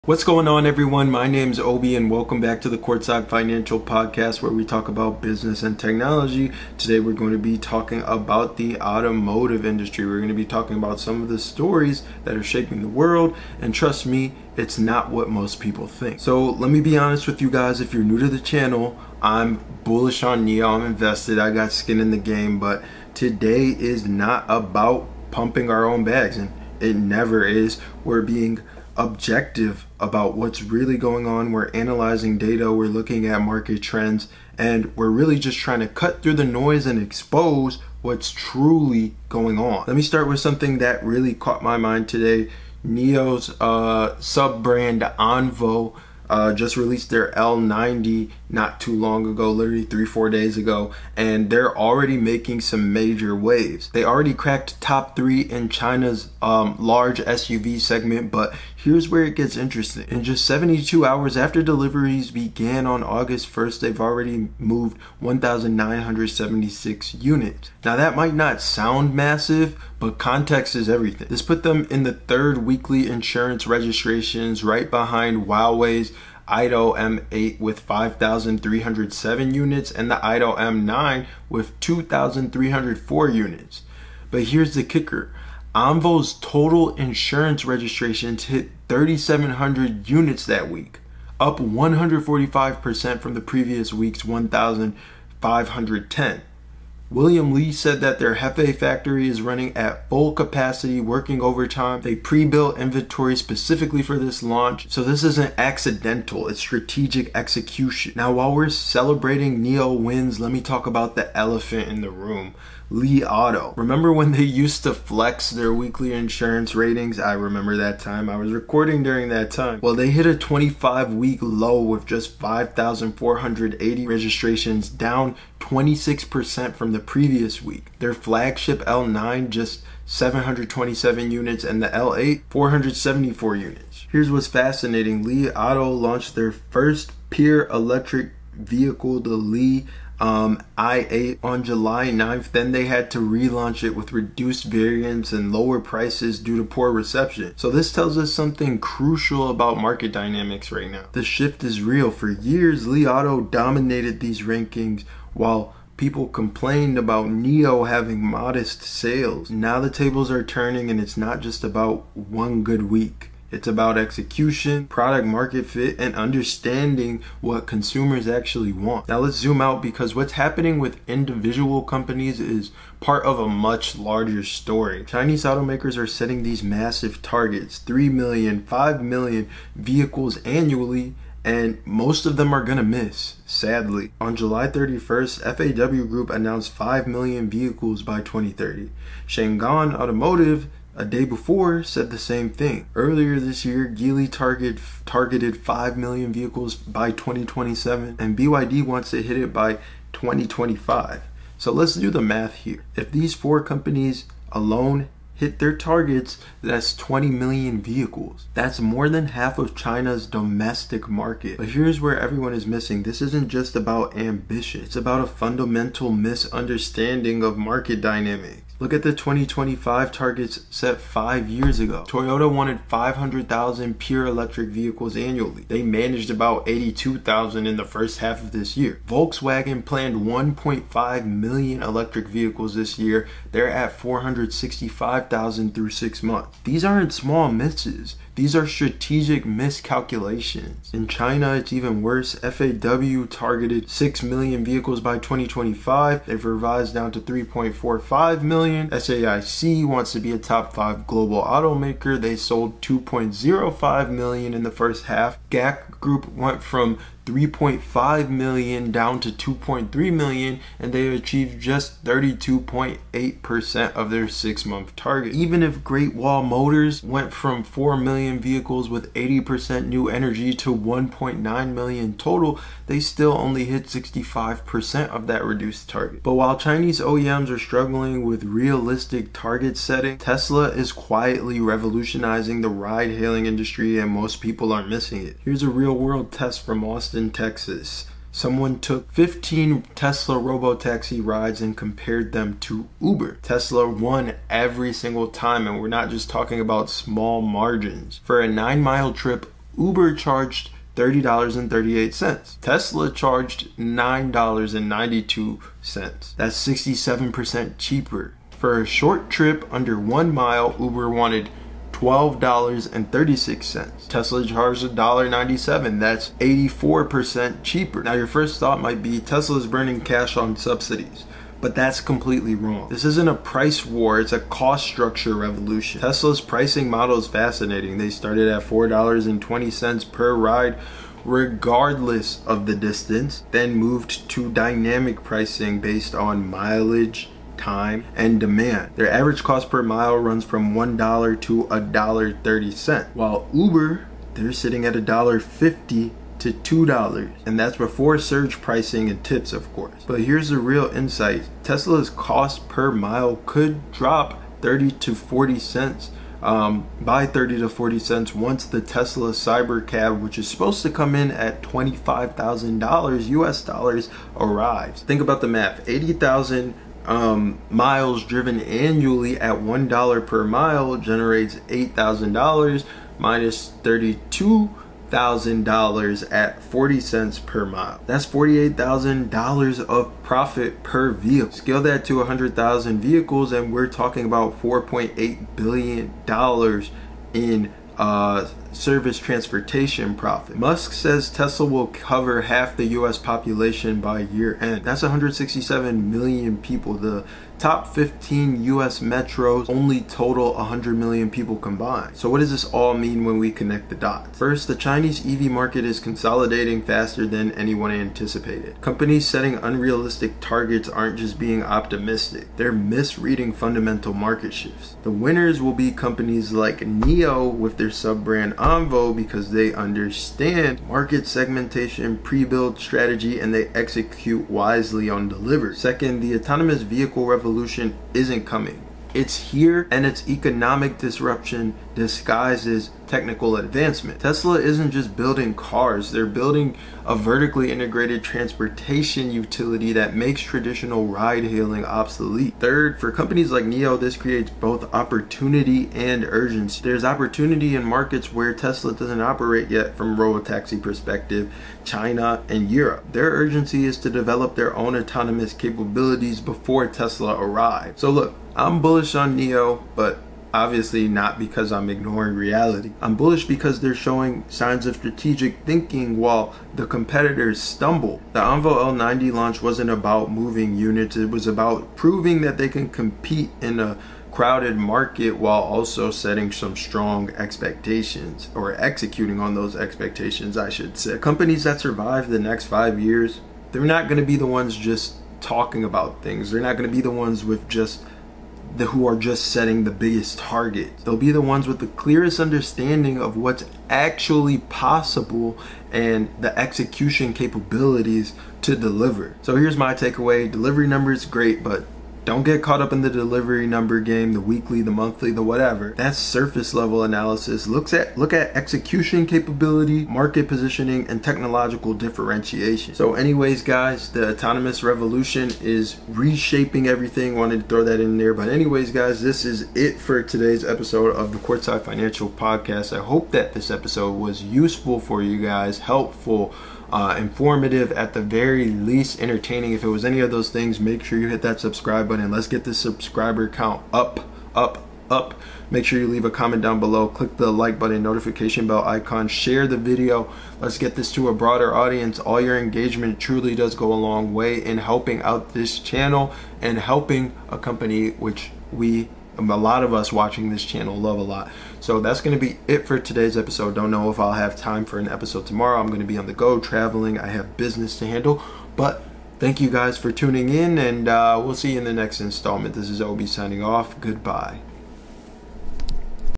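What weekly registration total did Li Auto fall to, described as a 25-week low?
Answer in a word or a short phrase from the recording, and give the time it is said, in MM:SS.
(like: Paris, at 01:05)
5,480, at 02:02.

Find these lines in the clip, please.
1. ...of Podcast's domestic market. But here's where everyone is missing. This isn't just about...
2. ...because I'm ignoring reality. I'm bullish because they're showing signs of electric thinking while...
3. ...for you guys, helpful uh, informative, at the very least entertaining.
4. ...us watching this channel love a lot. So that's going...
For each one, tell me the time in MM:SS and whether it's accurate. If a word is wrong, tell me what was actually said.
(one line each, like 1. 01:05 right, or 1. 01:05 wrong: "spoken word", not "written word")
1. 03:29 wrong: "China", not "Podcast"
2. 07:41 wrong: "strategic", not "electric"
3. 08:44 right
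4. 09:09 right.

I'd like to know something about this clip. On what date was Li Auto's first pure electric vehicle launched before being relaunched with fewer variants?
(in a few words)
July 9th.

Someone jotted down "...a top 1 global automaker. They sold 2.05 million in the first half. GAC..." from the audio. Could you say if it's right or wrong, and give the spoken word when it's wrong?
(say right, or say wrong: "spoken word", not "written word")
wrong: "5", not "1".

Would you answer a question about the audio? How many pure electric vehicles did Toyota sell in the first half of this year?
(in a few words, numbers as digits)
about 82,000.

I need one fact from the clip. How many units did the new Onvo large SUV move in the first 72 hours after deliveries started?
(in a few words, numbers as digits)
1,976.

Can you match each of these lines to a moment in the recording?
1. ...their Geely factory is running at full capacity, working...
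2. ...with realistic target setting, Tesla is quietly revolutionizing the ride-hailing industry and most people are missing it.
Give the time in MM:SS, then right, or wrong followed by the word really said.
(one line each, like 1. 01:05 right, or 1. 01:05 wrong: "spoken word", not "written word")
1. 01:38 wrong: "Hefei", not "Geely"
2. 04:38 right.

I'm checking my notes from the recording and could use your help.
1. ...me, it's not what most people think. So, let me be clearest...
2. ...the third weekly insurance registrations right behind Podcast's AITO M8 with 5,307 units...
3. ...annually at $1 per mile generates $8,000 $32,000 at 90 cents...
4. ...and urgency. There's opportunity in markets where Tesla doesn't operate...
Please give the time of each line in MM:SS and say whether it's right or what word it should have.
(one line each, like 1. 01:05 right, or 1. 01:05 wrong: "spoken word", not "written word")
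1. 00:14 wrong: "honest", not "clearest"
2. 01:12 wrong: "Huawei", not "Podcast"
3. 06:08 wrong: "40", not "90"
4. 07:25 right.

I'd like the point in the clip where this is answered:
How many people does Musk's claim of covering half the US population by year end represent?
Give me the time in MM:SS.
06:35.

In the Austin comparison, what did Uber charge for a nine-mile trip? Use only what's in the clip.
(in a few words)
$30.38.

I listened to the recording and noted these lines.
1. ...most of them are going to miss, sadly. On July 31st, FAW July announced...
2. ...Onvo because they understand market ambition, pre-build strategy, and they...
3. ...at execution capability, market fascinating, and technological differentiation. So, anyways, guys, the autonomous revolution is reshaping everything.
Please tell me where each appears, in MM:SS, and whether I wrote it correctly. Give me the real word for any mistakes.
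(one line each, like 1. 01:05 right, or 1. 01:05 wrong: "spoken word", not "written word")
1. 03:01 wrong: "Group", not "July"
2. 06:58 wrong: "segmentation", not "ambition"
3. 08:28 wrong: "positioning", not "fascinating".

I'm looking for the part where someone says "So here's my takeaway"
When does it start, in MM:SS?
08:19.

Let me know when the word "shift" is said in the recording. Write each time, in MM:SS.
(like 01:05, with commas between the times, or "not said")
02:31, 06:54.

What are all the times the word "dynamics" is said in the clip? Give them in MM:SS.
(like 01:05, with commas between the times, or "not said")
02:30, 03:38, 05:34.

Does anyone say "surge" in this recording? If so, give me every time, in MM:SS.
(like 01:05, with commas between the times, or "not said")
05:48.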